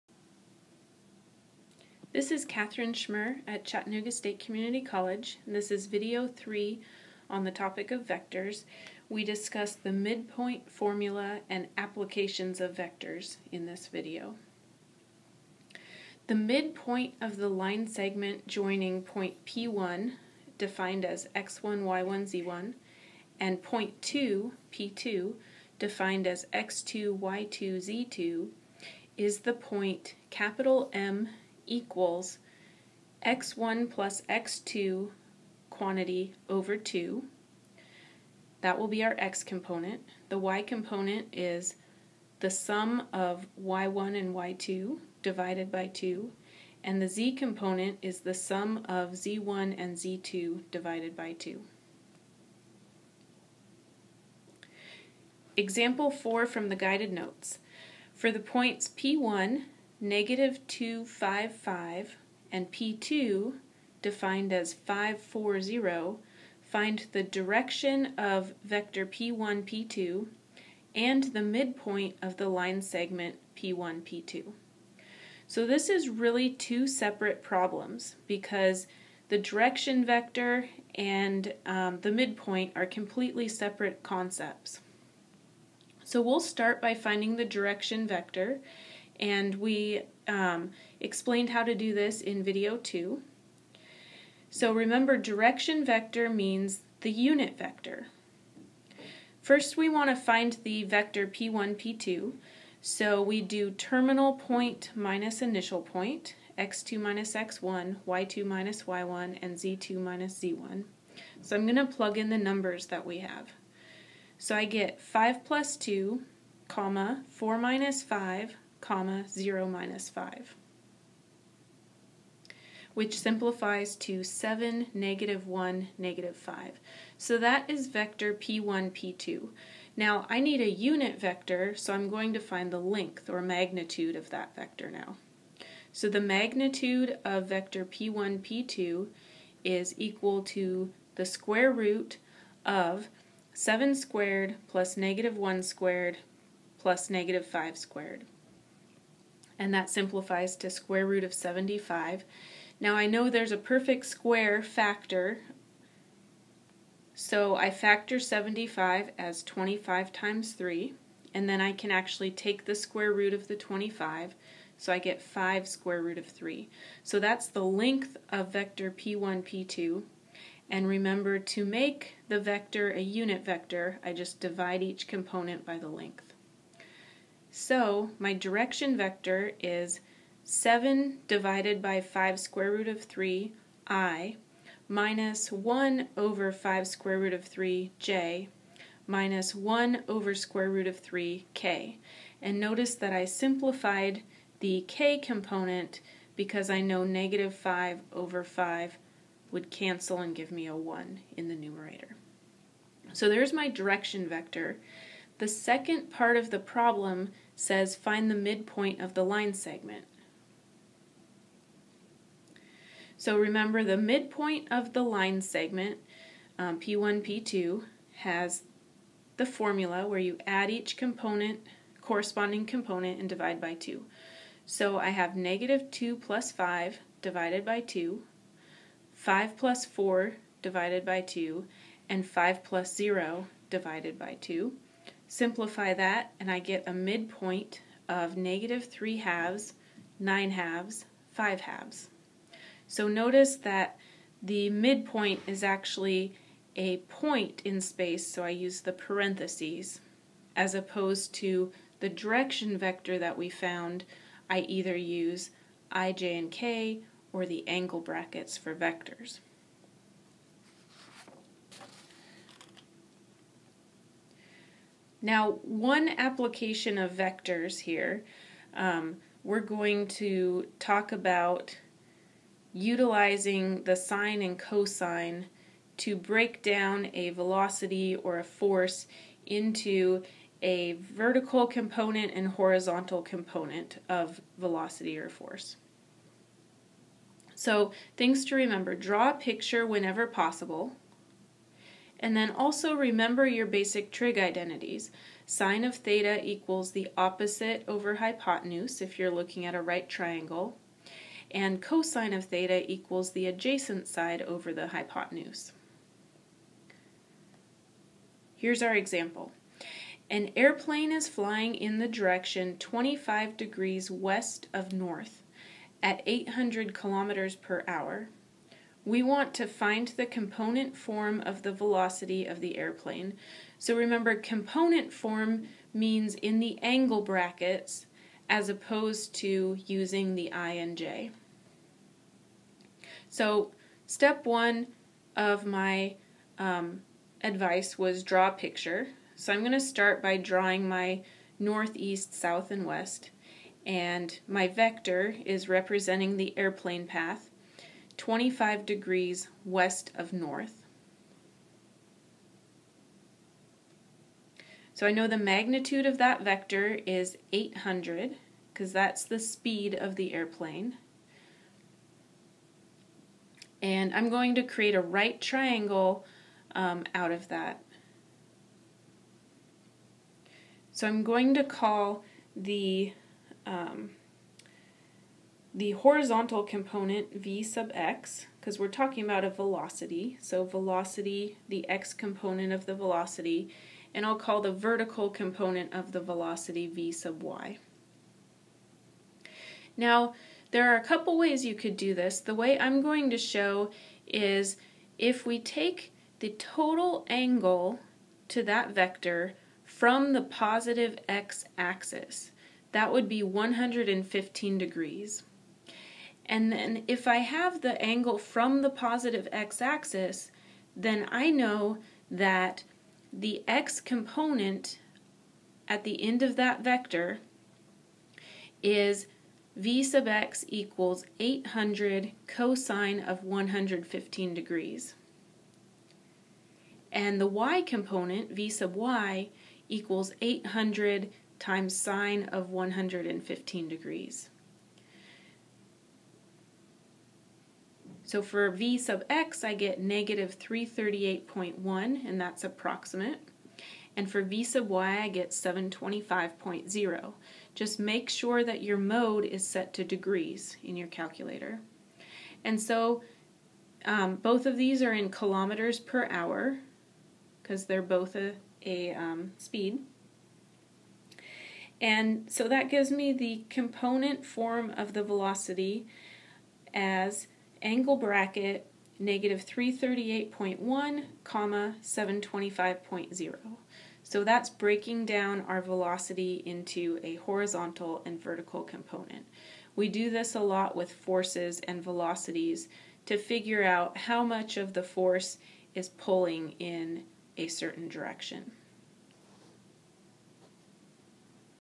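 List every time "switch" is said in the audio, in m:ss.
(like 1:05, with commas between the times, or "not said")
not said.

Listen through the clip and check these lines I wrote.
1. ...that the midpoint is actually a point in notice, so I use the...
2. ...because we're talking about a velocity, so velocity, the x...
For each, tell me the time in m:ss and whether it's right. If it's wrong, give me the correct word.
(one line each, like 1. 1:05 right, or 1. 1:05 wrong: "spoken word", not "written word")
1. 4:03 wrong: "space", not "notice"
2. 6:18 right.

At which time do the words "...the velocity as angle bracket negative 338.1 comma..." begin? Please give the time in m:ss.
7:45.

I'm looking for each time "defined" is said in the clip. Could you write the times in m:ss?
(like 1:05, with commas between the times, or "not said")
0:20, 0:25, 1:04.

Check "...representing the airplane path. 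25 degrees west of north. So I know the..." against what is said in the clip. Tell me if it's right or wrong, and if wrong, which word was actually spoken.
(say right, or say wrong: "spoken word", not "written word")
right.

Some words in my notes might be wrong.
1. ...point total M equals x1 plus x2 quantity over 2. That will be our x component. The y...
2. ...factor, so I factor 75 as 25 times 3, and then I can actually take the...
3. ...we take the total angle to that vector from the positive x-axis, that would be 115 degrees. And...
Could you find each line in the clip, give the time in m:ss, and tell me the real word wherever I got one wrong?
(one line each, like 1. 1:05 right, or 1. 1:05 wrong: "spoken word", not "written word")
1. 0:29 wrong: "capital", not "total"
2. 2:34 right
3. 6:35 right.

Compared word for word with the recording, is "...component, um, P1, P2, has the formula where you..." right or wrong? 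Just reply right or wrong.
wrong.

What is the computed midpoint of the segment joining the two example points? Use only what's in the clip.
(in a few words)
(-3/2, 9/2, 5/2).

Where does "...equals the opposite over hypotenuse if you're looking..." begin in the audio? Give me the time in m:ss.
4:56.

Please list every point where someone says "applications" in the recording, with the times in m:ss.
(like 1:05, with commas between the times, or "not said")
0:11, 4:26.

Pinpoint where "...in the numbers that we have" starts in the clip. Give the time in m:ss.
1:52.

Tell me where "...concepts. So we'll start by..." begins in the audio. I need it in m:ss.
1:24.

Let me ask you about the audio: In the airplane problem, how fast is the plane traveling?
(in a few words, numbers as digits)
800 km/h.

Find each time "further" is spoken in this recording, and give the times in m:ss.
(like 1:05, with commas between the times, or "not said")
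not said.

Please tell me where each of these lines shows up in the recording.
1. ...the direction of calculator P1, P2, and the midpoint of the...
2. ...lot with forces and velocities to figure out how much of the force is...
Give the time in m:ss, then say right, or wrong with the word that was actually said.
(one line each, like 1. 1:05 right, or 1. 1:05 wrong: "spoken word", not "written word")
1. 1:07 wrong: "vector", not "calculator"
2. 8:00 right.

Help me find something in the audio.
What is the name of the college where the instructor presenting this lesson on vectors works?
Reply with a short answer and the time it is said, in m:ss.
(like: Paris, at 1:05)
Chattanooga State Community College, at 0:03.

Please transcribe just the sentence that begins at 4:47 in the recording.
So, things to remember draw a picture whenever possible.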